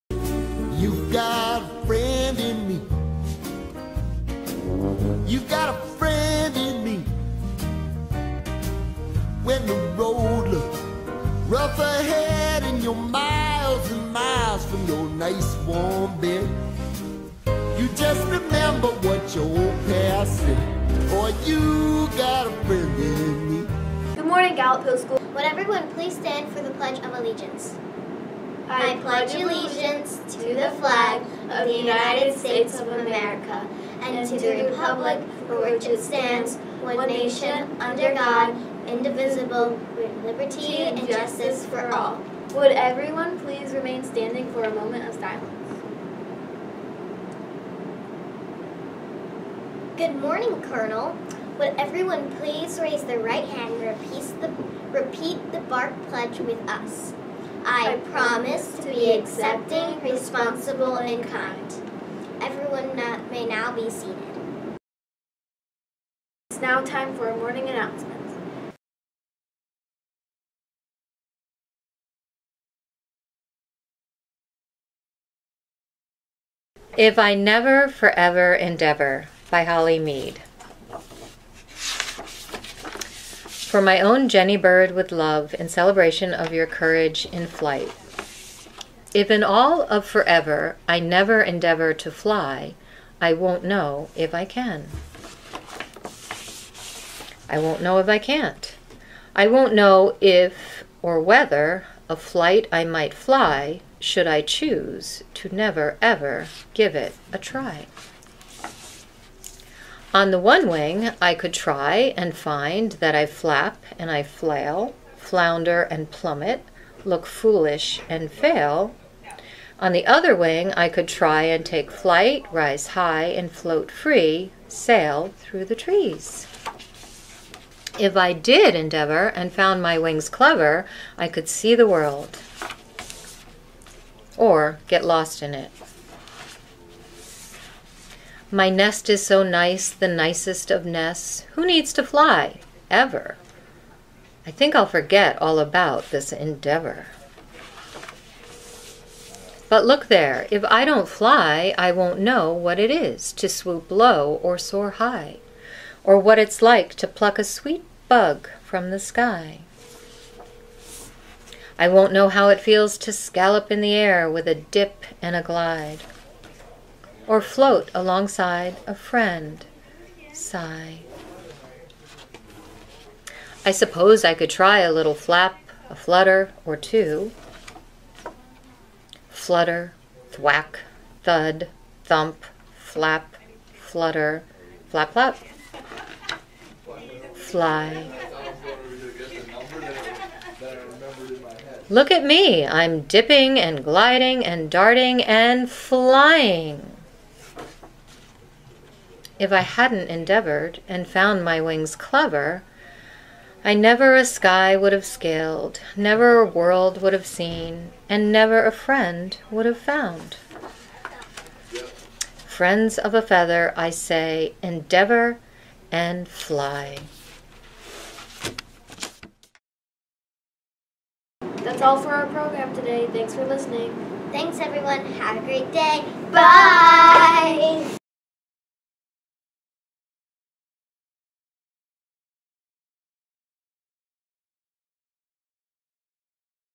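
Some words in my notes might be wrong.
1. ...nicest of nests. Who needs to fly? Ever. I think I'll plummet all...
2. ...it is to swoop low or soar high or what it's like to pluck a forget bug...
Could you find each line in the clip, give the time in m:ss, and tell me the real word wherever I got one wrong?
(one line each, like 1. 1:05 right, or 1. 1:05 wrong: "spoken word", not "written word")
1. 2:20 wrong: "forget", not "plummet"
2. 2:32 wrong: "sweet", not "forget".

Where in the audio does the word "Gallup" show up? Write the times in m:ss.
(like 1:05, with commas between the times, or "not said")
0:24.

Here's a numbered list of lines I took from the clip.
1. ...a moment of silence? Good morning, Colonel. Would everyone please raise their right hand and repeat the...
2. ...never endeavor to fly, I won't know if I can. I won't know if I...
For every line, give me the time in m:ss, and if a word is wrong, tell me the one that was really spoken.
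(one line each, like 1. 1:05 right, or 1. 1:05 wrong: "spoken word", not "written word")
1. 0:44 right
2. 1:31 right.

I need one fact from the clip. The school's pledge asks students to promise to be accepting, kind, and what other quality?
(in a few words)
Responsible.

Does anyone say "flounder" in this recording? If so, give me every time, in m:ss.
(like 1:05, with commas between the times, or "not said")
1:55.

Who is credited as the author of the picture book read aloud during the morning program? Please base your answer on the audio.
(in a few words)
Holly Meade.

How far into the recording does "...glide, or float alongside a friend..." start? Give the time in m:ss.
2:45.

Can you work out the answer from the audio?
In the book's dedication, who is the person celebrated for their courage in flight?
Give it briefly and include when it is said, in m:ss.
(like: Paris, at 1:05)
Jenny Bird, at 1:24.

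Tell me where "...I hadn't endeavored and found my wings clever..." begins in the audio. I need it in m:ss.
3:19.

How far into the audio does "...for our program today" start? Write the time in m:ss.
3:42.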